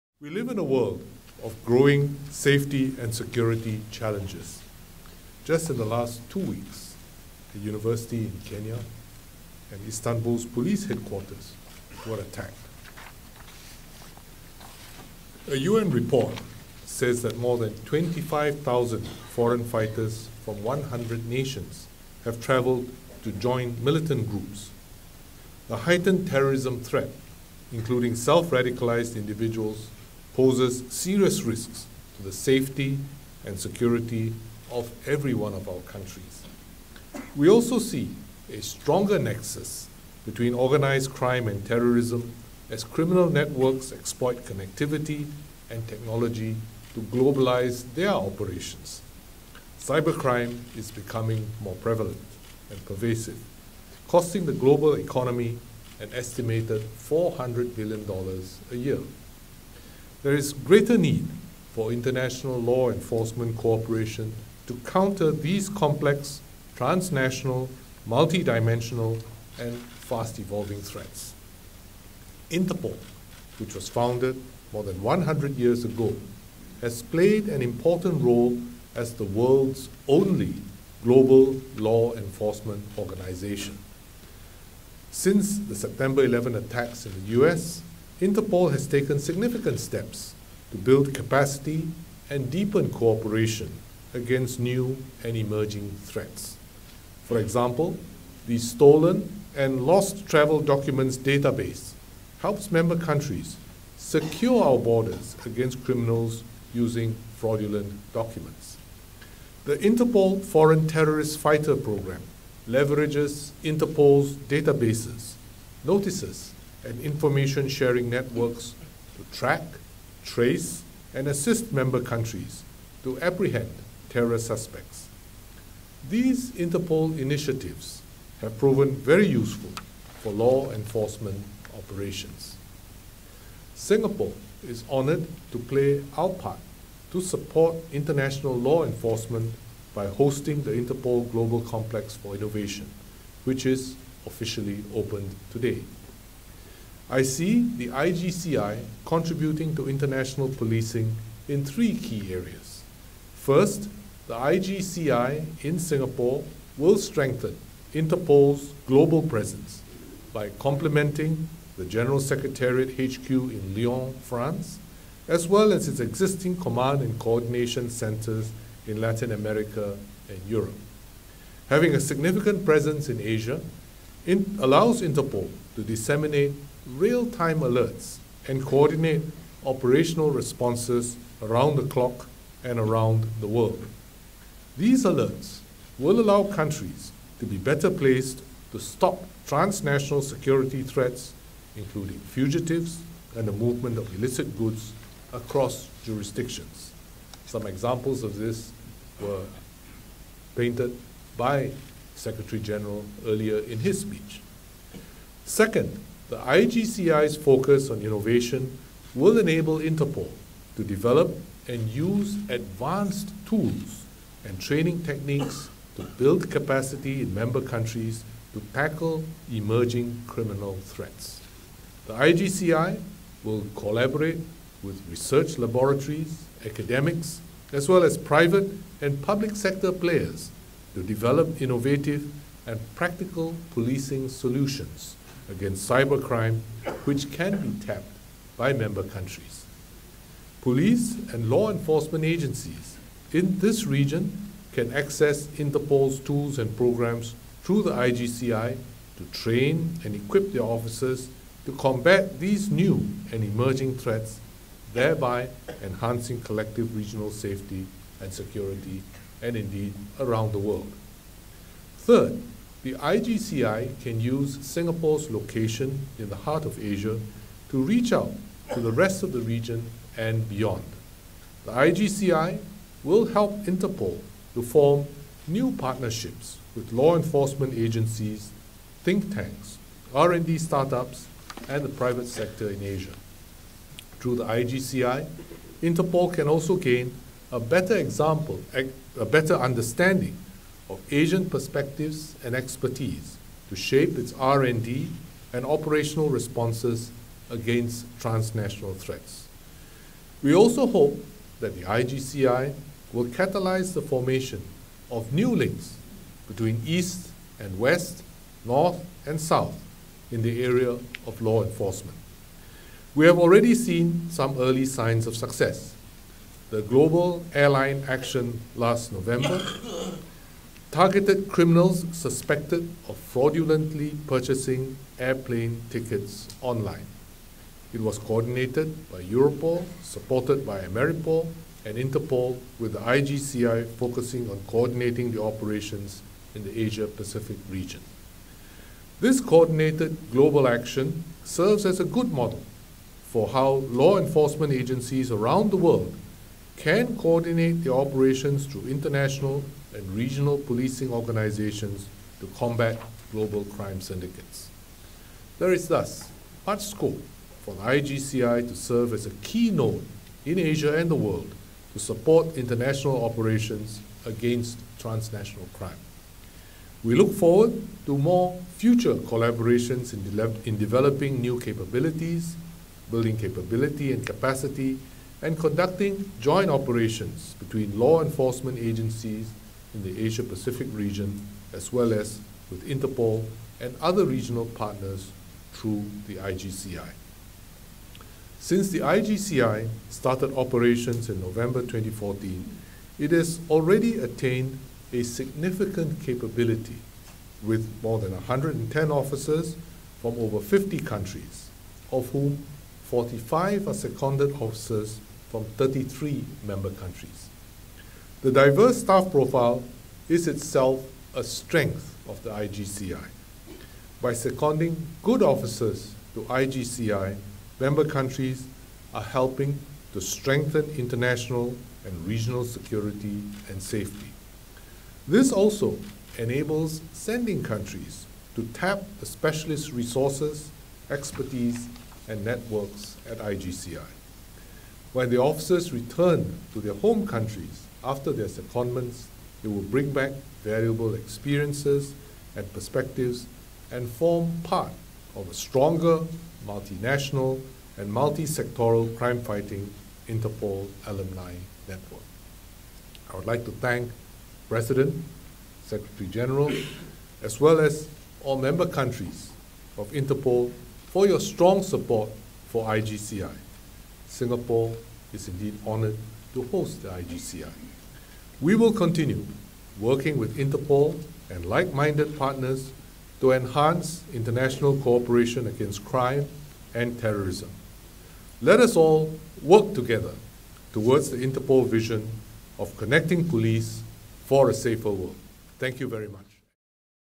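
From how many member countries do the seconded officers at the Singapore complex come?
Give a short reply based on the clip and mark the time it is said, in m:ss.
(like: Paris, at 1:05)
33, at 6:45.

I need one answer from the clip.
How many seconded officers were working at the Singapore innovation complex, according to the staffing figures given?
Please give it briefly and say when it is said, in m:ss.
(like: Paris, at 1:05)
45, at 6:43.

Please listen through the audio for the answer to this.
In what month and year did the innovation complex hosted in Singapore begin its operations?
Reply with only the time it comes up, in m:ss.
6:31.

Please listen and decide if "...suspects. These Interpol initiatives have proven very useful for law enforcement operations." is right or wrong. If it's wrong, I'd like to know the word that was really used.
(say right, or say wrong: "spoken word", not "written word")
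right.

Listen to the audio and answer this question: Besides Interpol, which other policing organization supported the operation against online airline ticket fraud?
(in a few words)
Ameripol.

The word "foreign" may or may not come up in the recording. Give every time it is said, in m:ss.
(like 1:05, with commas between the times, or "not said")
0:19, 1:50.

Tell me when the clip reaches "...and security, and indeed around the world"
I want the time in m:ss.
4:18.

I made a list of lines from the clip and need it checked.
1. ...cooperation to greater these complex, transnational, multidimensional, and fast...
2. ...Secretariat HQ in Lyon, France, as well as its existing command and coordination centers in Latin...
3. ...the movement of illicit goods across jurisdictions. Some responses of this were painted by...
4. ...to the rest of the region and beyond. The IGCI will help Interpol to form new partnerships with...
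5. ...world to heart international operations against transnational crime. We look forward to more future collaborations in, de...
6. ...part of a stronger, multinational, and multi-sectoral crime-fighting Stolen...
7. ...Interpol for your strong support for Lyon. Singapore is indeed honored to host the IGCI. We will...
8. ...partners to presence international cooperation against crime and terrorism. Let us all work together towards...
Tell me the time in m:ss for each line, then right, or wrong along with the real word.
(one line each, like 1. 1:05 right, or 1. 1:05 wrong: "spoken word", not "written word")
1. 1:03 wrong: "counter", not "greater"
2. 2:42 right
3. 3:13 wrong: "examples", not "responses"
4. 4:28 right
5. 6:01 wrong: "support", not "heart"
6. 7:24 wrong: "Interpol", not "Stolen"
7. 7:40 wrong: "IGCI", not "Lyon"
8. 7:52 wrong: "enhance", not "presence".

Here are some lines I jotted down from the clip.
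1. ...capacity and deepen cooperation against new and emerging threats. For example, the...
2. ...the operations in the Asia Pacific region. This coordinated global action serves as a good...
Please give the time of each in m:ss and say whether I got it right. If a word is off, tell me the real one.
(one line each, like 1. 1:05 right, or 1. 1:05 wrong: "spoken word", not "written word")
1. 1:31 right
2. 5:35 right.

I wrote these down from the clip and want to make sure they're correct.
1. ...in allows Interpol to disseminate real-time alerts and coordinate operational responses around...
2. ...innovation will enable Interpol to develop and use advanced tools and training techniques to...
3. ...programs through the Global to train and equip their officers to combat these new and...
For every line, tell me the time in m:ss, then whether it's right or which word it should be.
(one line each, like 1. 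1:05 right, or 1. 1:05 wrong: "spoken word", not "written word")
1. 2:54 right
2. 3:28 right
3. 4:06 wrong: "IGCI", not "Global".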